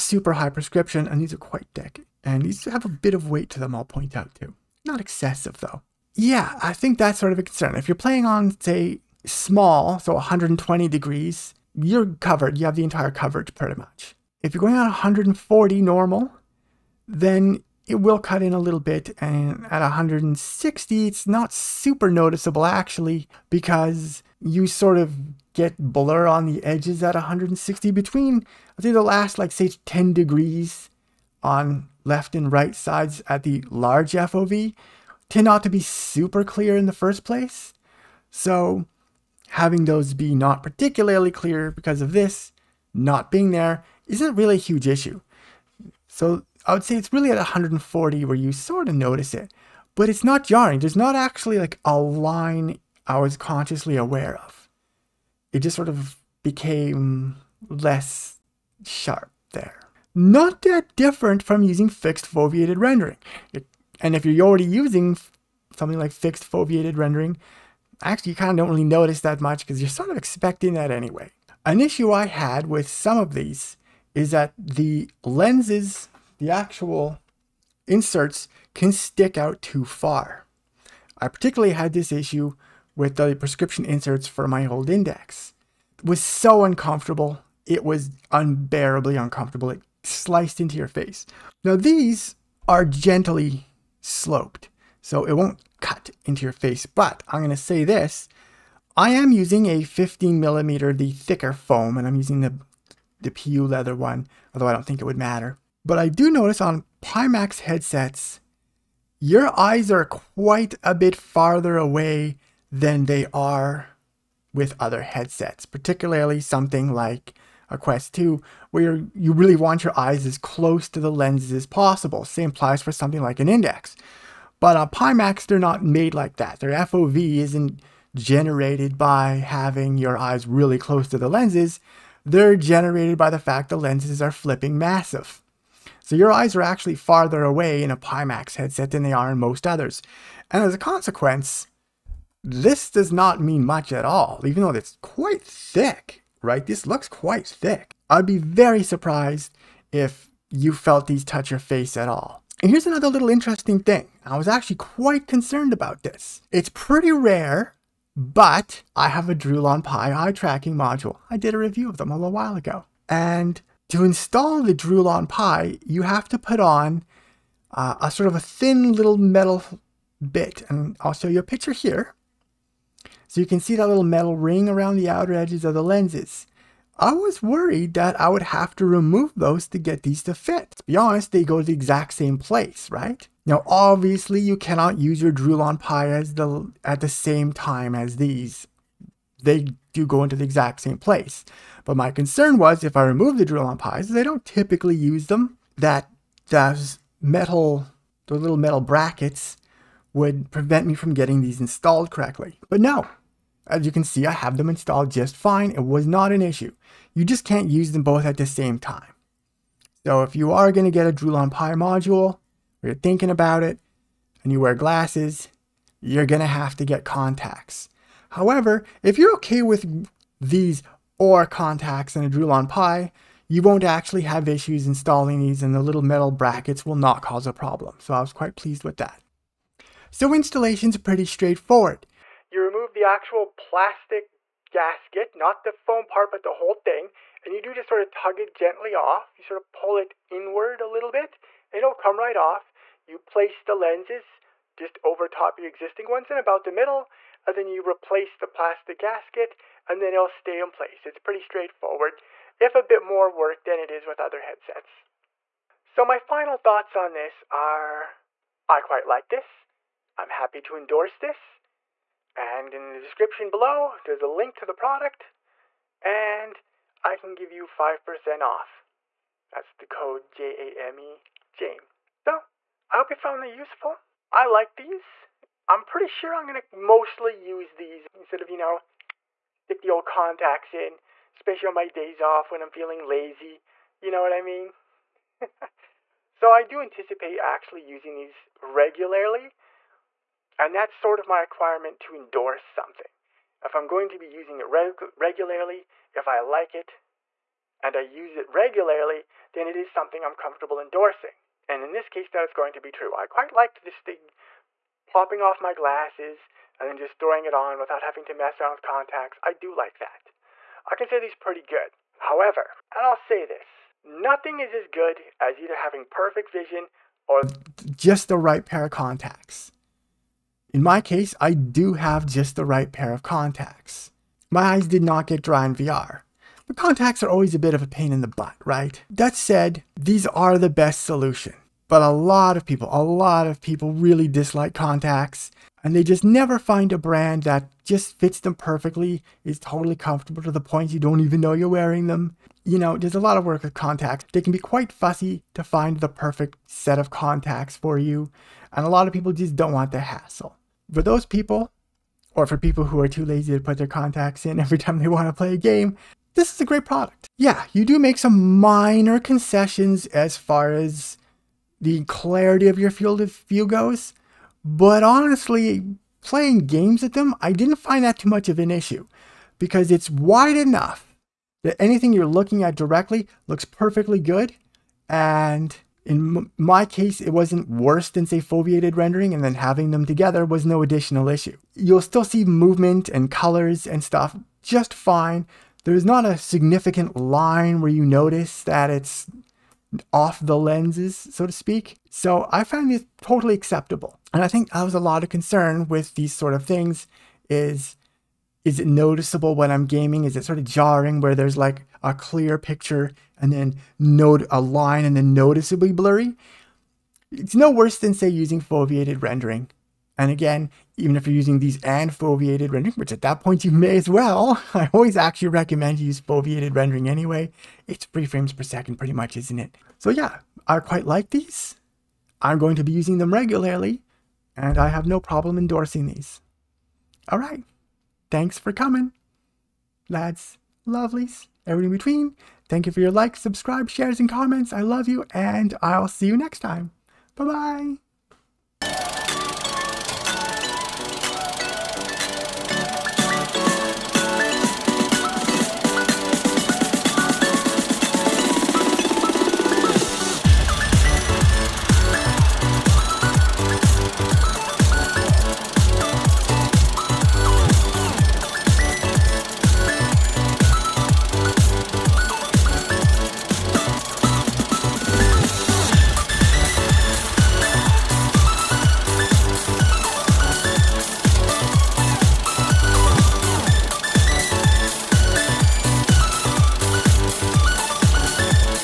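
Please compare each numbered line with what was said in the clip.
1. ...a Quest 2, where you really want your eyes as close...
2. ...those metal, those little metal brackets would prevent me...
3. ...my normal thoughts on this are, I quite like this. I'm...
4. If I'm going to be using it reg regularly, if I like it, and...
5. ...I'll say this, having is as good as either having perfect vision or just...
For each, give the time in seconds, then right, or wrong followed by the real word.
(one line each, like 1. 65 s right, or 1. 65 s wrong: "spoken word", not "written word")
1. 117 s right
2. 196 s right
3. 256 s wrong: "final", not "normal"
4. 293 s right
5. 313 s wrong: "nothing", not "having".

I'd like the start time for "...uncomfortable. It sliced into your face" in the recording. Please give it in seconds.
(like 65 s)
89 s.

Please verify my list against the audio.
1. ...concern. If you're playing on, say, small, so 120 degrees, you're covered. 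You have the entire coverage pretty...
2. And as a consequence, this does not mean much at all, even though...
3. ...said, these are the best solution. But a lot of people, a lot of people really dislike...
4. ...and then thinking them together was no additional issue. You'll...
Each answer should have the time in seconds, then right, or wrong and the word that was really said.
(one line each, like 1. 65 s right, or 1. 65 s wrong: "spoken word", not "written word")
1. 7 s right
2. 140 s right
3. 329 s right
4. 379 s wrong: "having", not "thinking".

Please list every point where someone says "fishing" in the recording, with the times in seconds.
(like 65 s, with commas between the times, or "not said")
not said.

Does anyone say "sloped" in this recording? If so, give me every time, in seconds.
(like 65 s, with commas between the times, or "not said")
93 s.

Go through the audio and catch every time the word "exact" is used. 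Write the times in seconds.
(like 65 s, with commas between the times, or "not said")
181 s, 190 s.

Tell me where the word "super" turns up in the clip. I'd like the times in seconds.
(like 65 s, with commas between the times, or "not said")
21 s, 35 s.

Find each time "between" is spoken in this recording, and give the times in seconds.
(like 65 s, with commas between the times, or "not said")
27 s, 431 s.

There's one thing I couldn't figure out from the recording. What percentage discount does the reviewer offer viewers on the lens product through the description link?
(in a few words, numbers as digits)
5%.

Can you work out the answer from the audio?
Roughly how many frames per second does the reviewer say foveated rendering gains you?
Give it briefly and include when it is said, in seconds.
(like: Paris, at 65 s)
3, at 418 s.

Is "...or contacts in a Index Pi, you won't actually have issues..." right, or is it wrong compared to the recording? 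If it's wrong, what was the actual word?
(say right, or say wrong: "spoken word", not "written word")
wrong: "Droolon", not "Index".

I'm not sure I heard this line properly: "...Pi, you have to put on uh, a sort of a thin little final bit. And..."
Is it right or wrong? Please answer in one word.
wrong.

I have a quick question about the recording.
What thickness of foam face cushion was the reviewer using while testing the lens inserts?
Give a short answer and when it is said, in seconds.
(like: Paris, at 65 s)
15 millimeter, at 99 s.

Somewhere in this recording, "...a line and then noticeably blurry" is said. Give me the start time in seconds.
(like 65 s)
404 s.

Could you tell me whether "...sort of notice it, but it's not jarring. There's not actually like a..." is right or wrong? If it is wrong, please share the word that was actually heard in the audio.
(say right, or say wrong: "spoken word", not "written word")
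right.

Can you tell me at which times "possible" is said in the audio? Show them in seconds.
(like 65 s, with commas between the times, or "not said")
121 s.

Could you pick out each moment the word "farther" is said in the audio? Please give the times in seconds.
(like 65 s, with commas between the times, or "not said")
111 s, 136 s.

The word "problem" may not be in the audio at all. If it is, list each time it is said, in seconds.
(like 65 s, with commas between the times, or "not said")
227 s, 425 s.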